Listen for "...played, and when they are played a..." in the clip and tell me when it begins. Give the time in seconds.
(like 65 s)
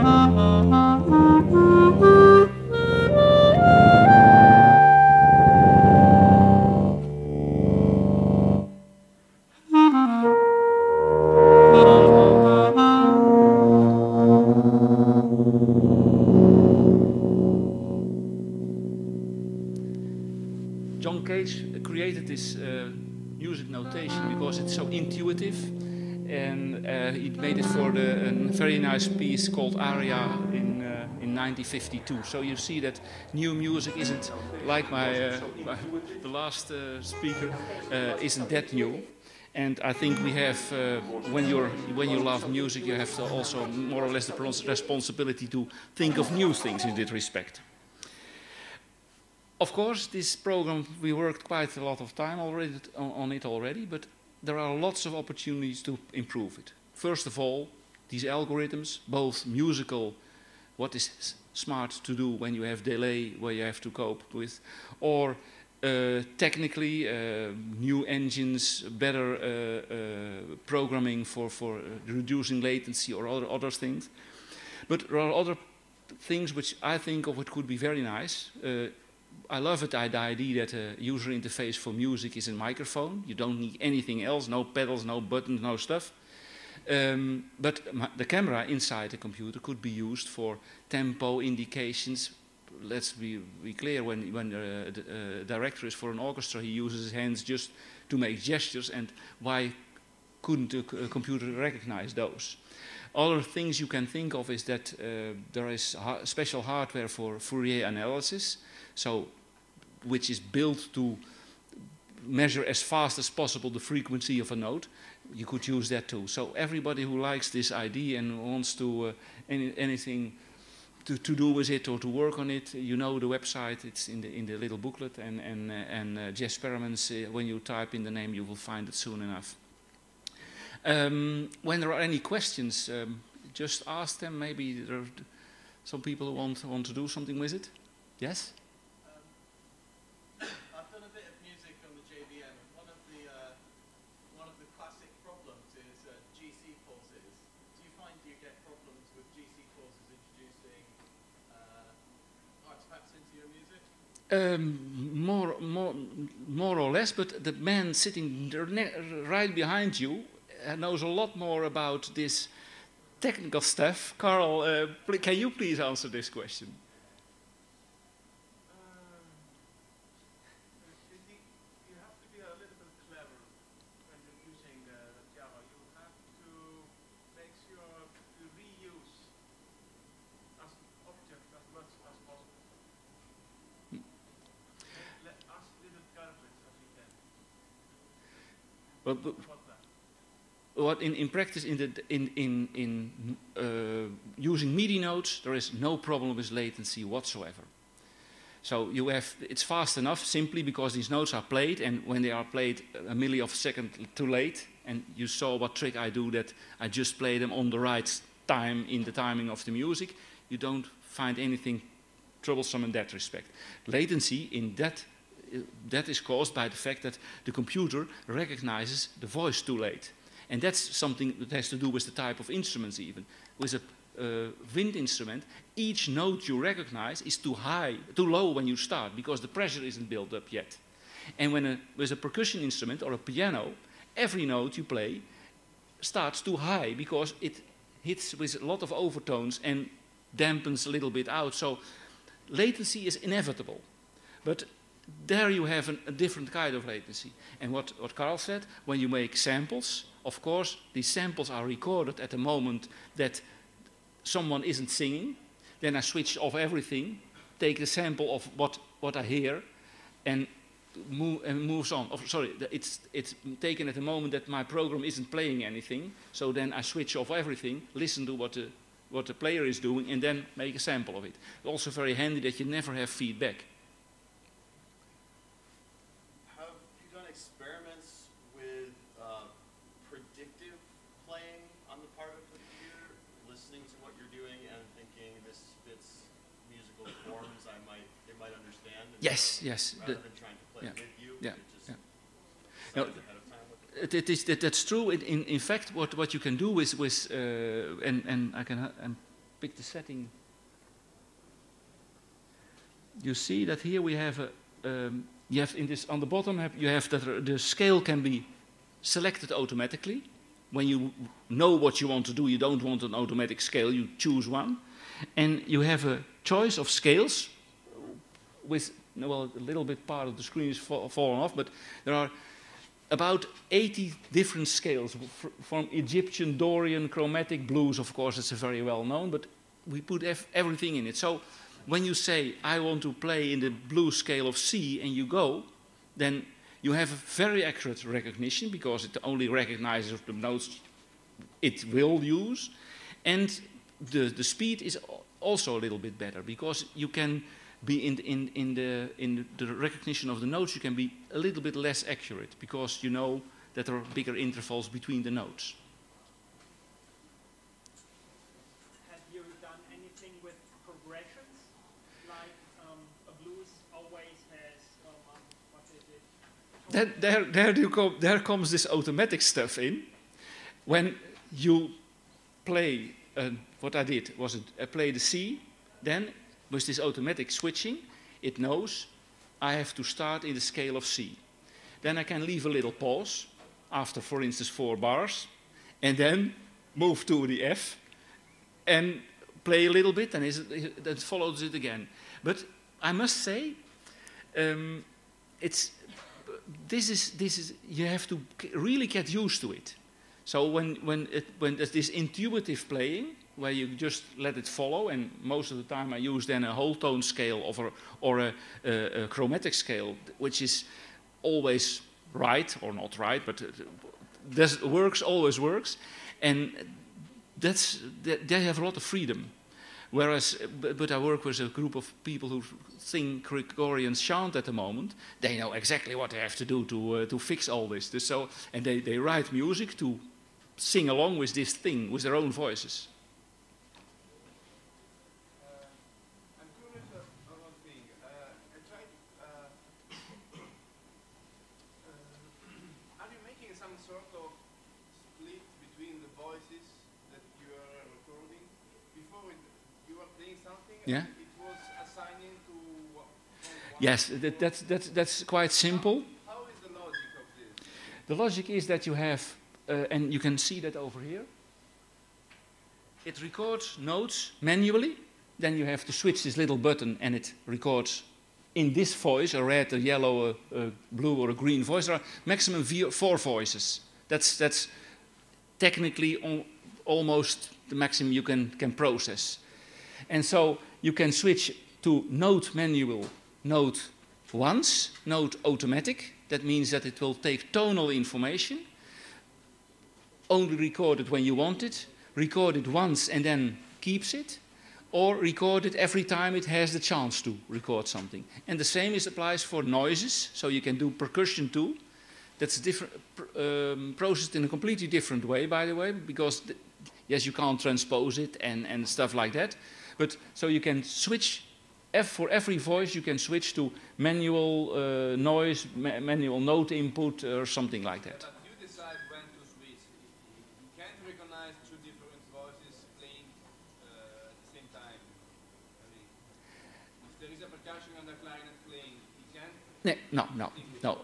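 201 s.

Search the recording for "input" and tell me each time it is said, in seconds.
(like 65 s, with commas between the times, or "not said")
516 s.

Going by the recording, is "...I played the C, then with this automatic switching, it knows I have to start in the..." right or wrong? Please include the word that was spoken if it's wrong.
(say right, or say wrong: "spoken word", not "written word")
right.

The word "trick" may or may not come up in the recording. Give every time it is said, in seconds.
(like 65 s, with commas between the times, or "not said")
205 s.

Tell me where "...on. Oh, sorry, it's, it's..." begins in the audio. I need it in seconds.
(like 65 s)
261 s.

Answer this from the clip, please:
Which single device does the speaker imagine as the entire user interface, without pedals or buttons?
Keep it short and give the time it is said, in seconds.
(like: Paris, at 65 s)
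microphone, at 82 s.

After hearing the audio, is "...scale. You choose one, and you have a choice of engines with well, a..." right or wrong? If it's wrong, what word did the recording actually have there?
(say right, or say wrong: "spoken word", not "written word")
wrong: "scales", not "engines".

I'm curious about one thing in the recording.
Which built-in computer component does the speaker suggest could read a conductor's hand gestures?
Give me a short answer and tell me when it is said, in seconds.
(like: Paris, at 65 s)
camera, at 88 s.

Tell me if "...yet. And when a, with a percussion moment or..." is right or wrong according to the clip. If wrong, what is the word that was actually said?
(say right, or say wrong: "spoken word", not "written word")
wrong: "instrument", not "moment".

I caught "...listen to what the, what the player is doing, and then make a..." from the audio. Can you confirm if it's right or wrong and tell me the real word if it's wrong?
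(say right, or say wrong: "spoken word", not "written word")
right.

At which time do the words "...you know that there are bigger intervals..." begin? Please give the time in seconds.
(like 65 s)
353 s.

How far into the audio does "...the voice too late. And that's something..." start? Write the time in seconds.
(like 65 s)
219 s.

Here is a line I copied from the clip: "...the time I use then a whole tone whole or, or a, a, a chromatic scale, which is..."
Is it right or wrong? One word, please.
wrong.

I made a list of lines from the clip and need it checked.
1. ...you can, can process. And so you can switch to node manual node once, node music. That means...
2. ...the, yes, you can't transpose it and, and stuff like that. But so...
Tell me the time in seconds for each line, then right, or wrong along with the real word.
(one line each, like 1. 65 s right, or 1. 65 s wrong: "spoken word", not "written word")
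1. 478 s wrong: "automatic", not "music"
2. 506 s right.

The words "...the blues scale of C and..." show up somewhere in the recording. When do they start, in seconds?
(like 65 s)
333 s.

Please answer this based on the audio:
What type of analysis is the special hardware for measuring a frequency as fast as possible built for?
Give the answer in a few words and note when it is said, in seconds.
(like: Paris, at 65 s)
Fourier analysis, at 107 s.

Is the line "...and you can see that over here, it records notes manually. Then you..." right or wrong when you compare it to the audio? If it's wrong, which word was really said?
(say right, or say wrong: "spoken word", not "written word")
right.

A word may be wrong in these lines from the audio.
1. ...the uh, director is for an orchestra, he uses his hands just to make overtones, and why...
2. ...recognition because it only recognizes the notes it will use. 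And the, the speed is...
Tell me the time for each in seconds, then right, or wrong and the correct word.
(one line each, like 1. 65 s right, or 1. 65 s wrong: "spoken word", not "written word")
1. 94 s wrong: "gestures", not "overtones"
2. 338 s right.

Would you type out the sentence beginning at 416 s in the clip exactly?
And that's, they have a lot of freedom.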